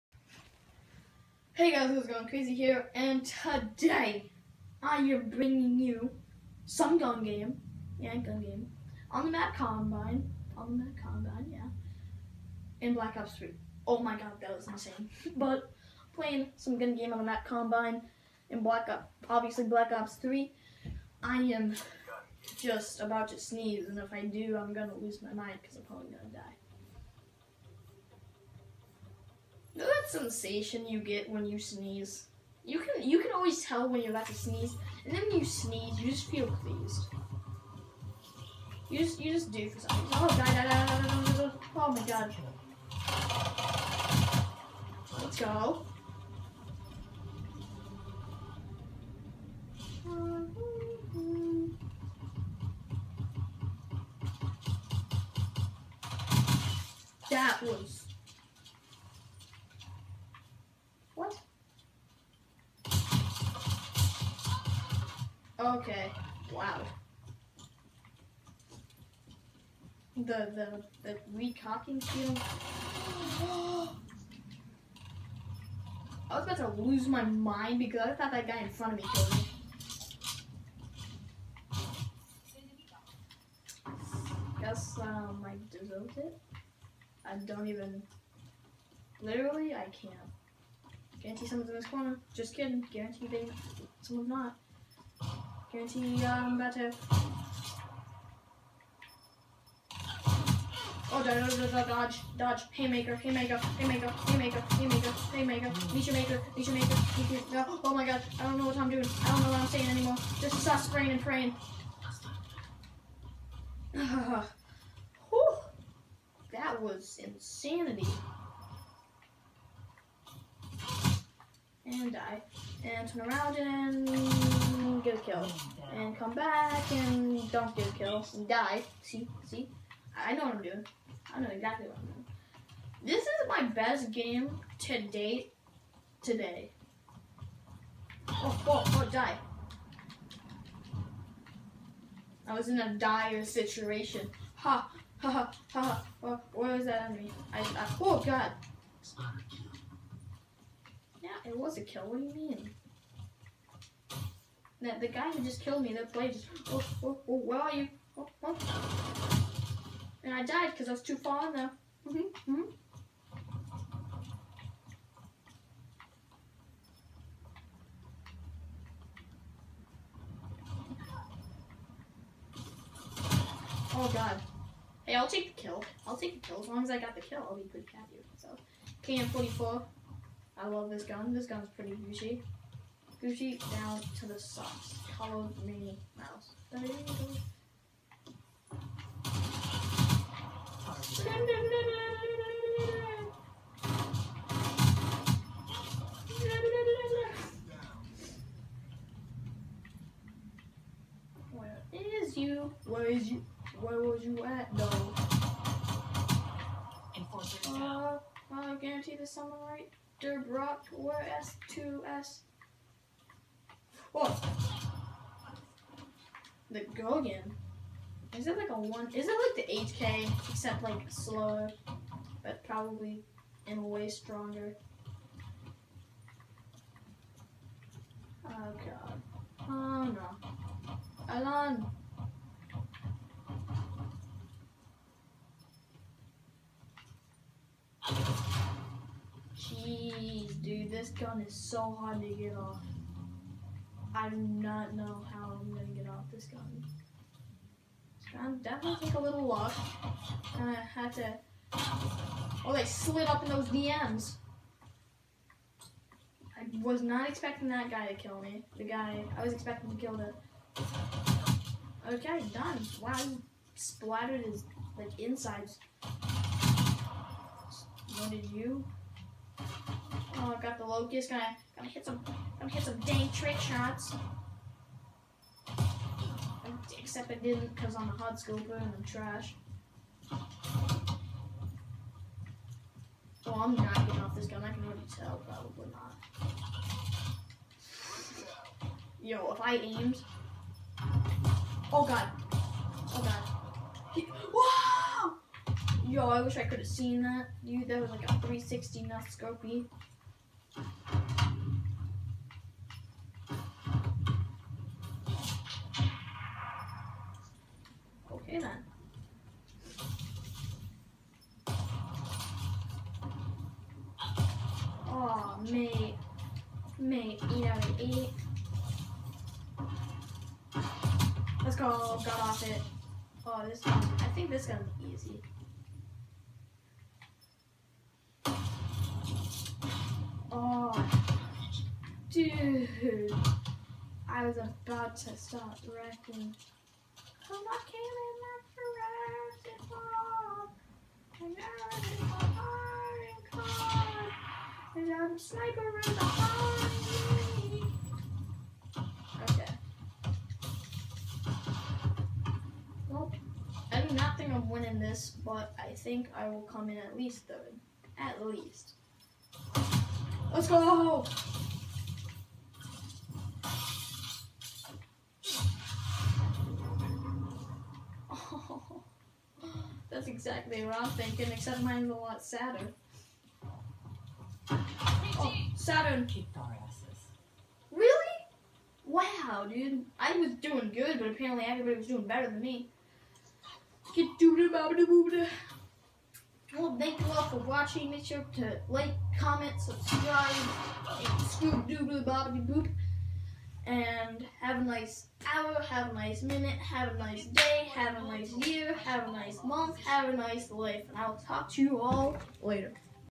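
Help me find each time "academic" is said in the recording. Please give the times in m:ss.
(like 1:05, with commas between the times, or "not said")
not said.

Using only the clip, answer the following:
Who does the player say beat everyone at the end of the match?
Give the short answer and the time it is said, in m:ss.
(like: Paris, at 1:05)
Saturn, at 6:15.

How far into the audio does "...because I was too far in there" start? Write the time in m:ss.
2:40.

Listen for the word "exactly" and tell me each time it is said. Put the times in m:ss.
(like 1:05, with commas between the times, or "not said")
2:11, 6:10.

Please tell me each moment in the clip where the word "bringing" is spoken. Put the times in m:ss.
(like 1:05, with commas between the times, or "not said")
0:05.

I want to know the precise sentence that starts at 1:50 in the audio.
Just is us praying and praying.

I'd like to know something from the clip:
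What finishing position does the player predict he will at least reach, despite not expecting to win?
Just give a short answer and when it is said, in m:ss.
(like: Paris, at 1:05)
Third, at 5:57.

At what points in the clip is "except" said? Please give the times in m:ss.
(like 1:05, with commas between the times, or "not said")
3:40, 4:36, 6:11.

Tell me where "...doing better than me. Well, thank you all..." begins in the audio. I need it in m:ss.
6:22.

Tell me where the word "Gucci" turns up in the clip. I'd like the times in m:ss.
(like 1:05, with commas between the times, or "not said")
3:03.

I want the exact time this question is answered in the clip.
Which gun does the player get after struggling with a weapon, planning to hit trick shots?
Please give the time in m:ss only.
4:30.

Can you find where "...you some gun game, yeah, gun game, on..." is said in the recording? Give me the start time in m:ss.
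0:05.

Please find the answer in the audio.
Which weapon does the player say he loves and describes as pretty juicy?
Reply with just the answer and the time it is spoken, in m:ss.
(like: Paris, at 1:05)
KN44, at 2:59.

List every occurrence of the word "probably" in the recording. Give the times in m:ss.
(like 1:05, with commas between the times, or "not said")
0:25, 3:42, 4:45.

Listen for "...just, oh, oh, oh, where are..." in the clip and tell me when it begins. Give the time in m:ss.
2:36.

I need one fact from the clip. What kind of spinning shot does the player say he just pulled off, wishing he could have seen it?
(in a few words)
360 nut scopey.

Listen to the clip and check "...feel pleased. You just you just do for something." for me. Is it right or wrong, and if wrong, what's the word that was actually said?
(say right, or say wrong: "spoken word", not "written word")
right.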